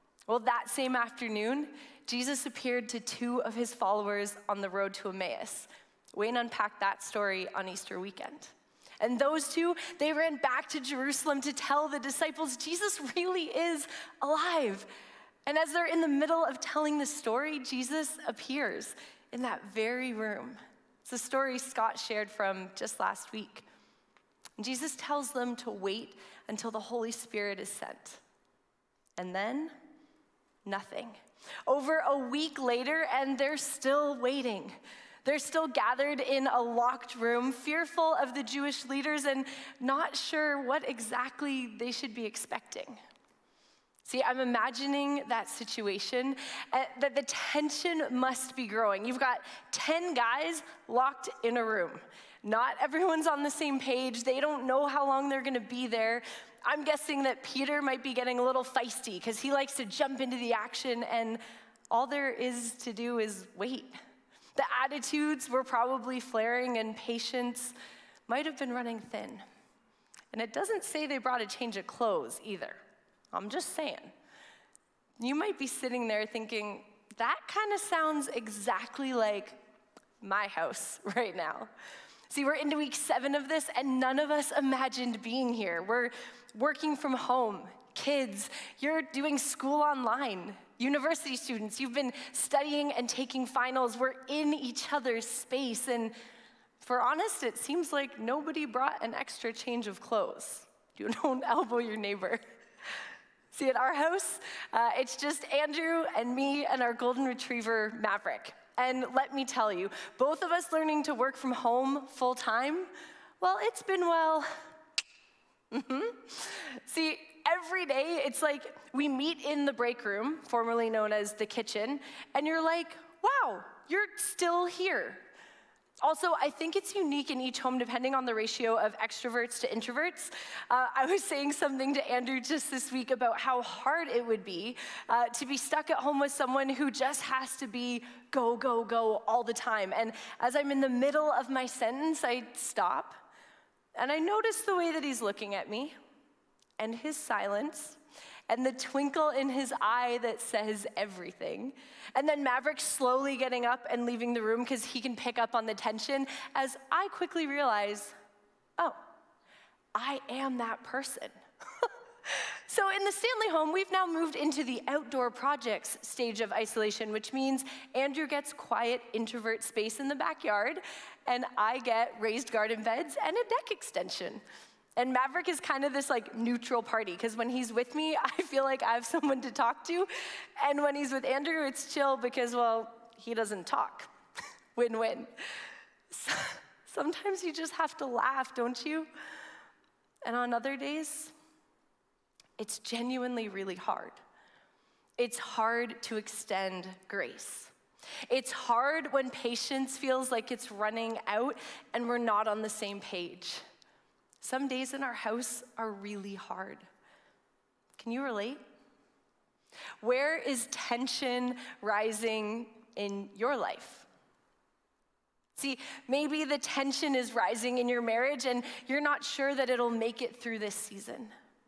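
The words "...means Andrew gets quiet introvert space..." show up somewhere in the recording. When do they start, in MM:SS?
02:47.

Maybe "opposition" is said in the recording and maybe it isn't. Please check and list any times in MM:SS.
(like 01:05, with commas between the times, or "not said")
not said.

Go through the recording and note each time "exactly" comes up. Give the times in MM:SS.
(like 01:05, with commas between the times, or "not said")
00:40, 01:18.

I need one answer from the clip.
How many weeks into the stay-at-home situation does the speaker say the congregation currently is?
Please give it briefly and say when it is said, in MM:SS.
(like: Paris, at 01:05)
7, at 01:22.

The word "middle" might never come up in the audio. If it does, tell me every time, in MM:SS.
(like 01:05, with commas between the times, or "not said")
00:16, 02:20.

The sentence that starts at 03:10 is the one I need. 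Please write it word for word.
And on other days, it's genuinely really hard.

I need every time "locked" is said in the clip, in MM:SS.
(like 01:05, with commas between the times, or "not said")
00:36, 00:50.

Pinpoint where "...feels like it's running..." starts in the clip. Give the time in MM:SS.
03:19.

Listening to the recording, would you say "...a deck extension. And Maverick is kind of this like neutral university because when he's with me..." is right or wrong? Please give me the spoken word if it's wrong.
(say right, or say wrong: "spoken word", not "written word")
wrong: "party", not "university".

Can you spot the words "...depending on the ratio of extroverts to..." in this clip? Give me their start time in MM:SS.
02:07.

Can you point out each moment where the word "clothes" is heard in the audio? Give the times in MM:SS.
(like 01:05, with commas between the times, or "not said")
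01:11, 01:39.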